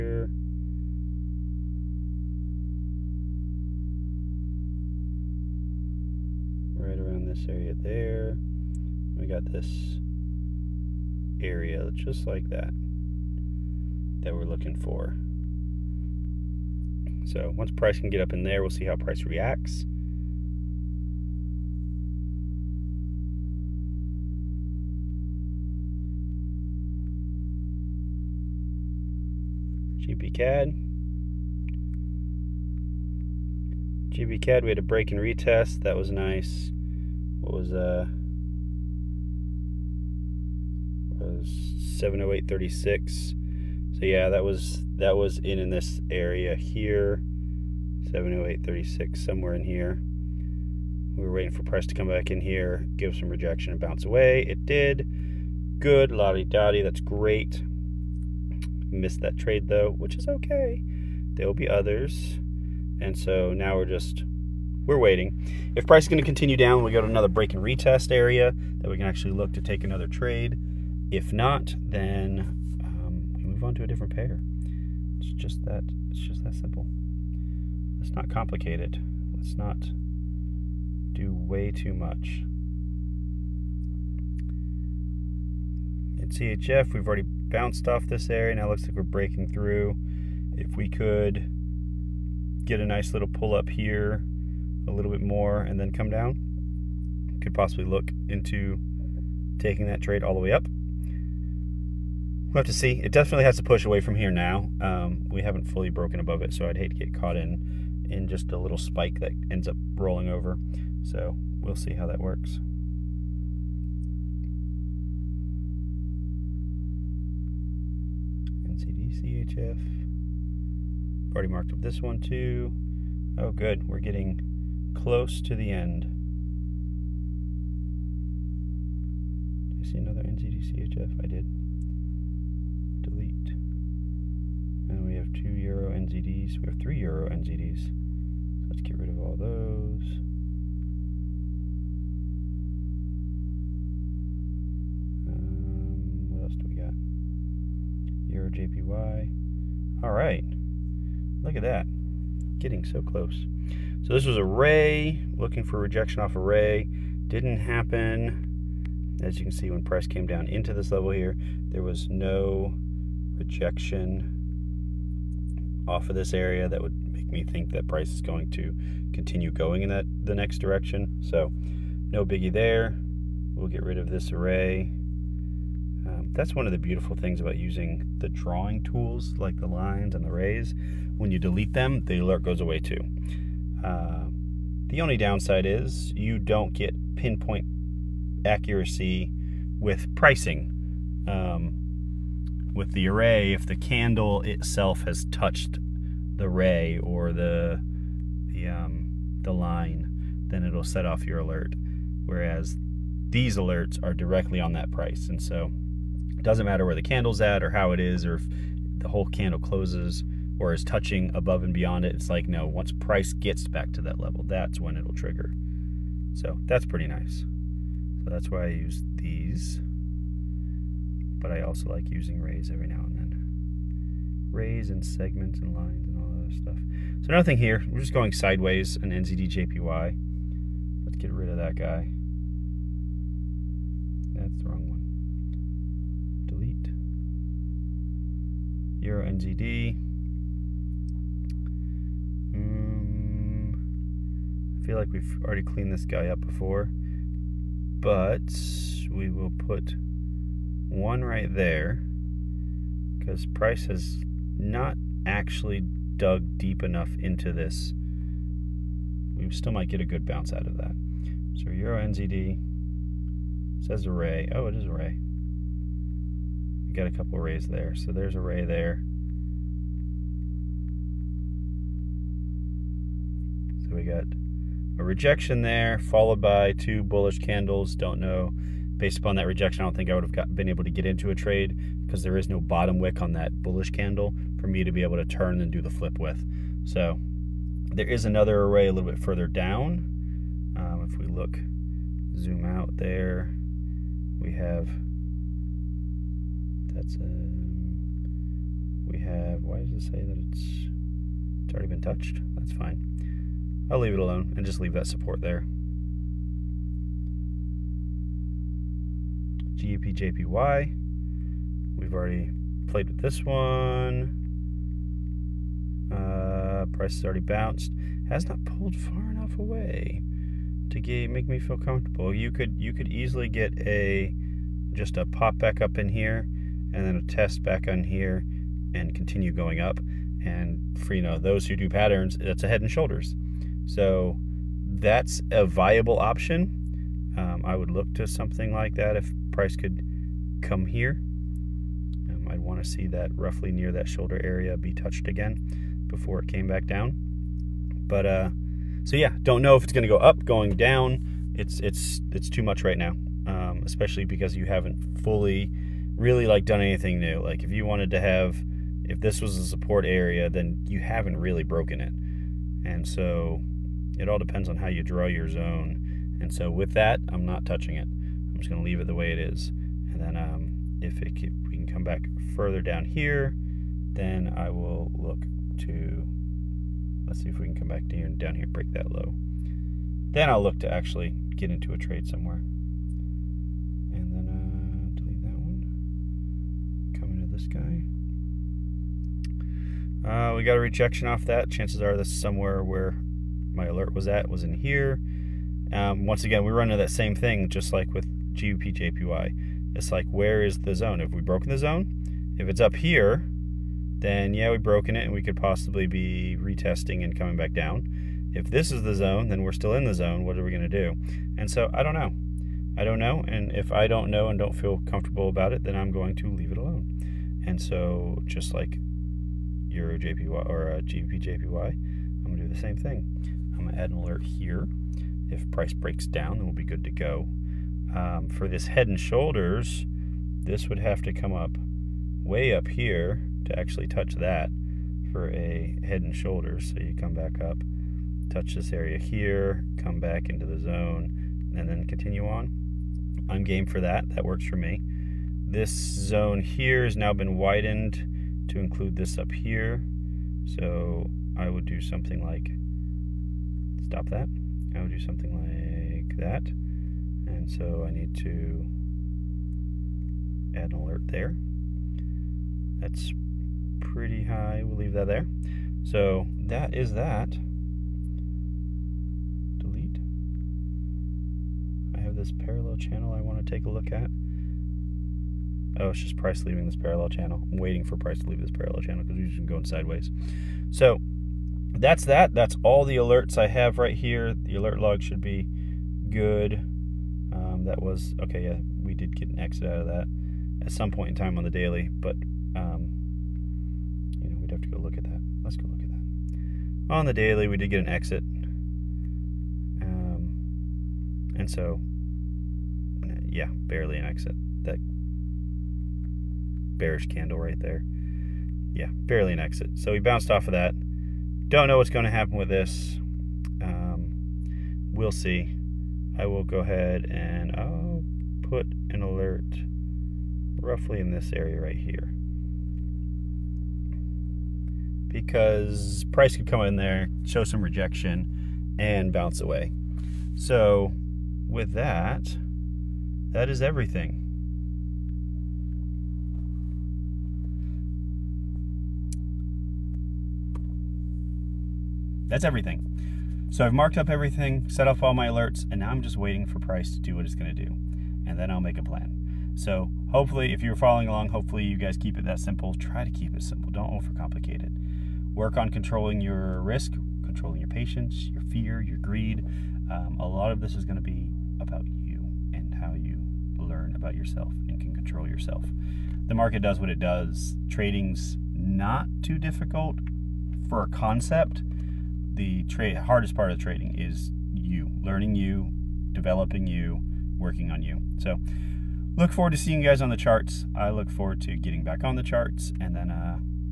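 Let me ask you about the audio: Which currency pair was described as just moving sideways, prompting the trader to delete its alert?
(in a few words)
NZDJPY.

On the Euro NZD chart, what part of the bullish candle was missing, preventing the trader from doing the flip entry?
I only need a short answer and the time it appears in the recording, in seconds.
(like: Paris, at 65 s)
bottom wick, at 282 s.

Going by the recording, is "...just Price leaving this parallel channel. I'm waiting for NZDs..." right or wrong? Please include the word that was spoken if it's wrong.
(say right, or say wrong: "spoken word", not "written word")
wrong: "Price", not "NZDs".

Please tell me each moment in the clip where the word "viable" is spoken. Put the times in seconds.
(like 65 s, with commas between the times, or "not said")
335 s.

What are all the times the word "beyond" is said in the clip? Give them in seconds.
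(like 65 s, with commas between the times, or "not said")
211 s.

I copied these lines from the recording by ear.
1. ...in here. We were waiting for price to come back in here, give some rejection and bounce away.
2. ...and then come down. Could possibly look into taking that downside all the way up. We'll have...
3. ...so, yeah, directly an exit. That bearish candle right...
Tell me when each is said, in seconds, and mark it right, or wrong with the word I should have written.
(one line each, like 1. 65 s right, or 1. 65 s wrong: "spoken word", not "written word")
1. 49 s right
2. 95 s wrong: "trade", not "downside"
3. 501 s wrong: "barely", not "directly".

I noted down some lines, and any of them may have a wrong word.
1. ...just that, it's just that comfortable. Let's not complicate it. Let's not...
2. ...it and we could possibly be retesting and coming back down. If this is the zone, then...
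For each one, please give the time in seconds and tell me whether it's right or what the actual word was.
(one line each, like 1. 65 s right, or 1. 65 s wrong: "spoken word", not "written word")
1. 75 s wrong: "simple", not "comfortable"
2. 405 s right.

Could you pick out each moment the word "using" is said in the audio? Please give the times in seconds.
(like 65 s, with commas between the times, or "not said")
177 s, 222 s.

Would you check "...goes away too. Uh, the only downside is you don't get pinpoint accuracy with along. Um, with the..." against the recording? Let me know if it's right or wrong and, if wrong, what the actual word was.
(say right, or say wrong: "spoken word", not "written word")
wrong: "pricing", not "along".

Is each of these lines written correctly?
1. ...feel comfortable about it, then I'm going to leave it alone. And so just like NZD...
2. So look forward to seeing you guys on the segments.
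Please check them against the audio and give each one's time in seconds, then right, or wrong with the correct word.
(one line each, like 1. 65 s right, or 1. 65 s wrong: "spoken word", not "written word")
1. 414 s wrong: "Euro", not "NZD"
2. 578 s wrong: "charts", not "segments".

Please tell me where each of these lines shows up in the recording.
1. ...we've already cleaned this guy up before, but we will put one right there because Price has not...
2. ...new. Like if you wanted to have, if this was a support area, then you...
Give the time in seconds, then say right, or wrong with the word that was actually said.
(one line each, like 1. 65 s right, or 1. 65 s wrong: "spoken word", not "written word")
1. 245 s right
2. 357 s right.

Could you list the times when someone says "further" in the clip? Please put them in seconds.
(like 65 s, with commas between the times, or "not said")
289 s, 372 s.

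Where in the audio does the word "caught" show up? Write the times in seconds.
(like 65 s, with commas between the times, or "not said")
107 s.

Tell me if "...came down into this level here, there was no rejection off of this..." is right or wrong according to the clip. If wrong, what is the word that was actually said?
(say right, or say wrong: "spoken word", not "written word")
right.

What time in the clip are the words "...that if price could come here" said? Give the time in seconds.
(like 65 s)
338 s.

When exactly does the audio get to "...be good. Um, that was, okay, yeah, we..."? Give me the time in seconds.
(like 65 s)
485 s.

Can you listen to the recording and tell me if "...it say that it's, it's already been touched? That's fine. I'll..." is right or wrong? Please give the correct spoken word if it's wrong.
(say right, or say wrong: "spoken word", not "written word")
right.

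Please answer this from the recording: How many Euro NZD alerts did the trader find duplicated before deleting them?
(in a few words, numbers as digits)
3.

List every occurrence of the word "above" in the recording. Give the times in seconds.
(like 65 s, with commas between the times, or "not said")
106 s, 211 s.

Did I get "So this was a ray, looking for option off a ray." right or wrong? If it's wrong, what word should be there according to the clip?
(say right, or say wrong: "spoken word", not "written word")
wrong: "rejection", not "option".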